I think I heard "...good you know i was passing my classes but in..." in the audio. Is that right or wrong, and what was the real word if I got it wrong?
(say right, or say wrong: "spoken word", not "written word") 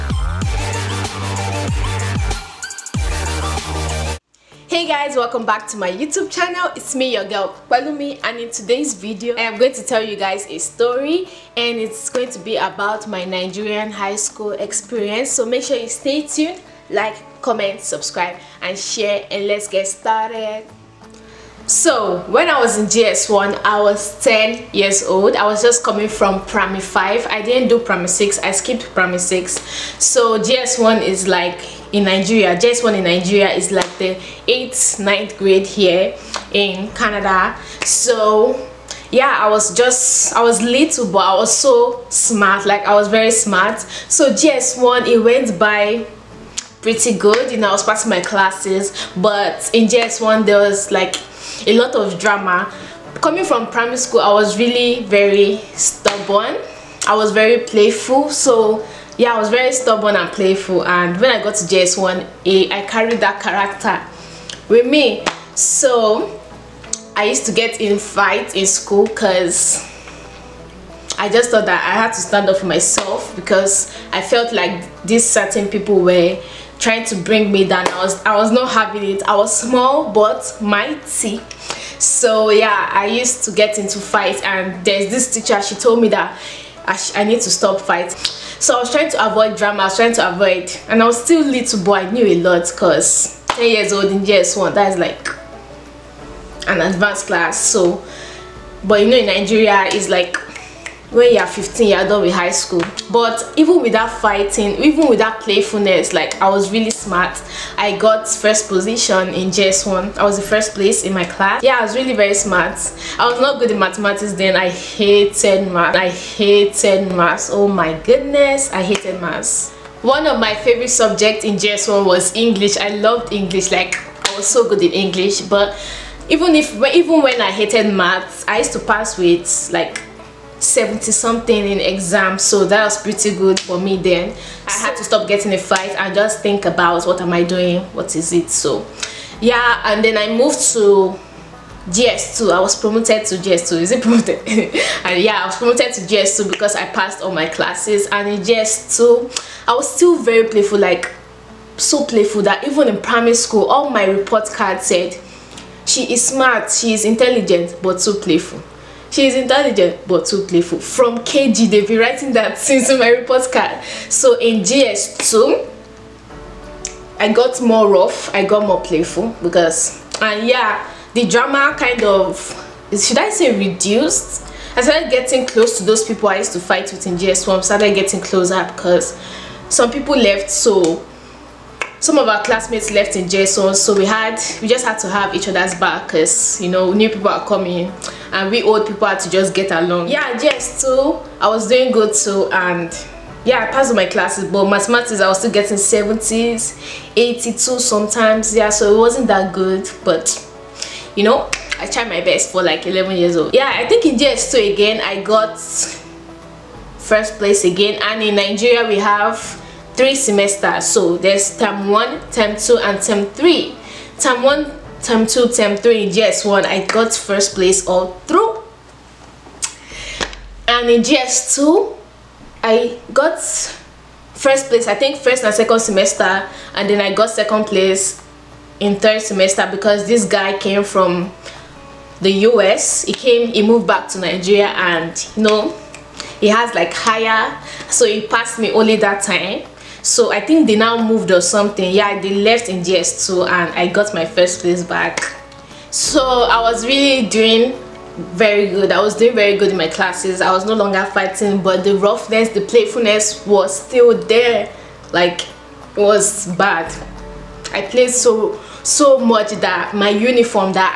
right.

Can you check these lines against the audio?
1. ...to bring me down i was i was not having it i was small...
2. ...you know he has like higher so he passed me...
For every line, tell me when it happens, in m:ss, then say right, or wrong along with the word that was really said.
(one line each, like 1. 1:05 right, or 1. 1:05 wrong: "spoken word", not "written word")
1. 1:17 right
2. 3:55 right.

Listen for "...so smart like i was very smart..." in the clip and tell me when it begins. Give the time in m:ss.
0:41.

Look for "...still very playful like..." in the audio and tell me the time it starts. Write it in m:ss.
2:29.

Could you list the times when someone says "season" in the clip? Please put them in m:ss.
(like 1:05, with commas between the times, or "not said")
not said.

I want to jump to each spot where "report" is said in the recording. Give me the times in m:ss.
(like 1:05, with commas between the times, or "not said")
2:34, 2:43.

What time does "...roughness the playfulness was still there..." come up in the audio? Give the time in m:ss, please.
4:11.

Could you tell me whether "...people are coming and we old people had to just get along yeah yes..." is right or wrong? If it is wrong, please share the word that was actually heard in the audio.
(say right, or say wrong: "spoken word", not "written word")
right.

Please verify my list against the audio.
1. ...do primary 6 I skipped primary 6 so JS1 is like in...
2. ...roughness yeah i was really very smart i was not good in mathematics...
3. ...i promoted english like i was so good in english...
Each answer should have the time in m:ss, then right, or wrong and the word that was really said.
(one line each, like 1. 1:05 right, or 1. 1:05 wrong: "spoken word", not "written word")
1. 0:27 right
2. 1:51 wrong: "class", not "roughness"
3. 2:02 wrong: "loved", not "promoted".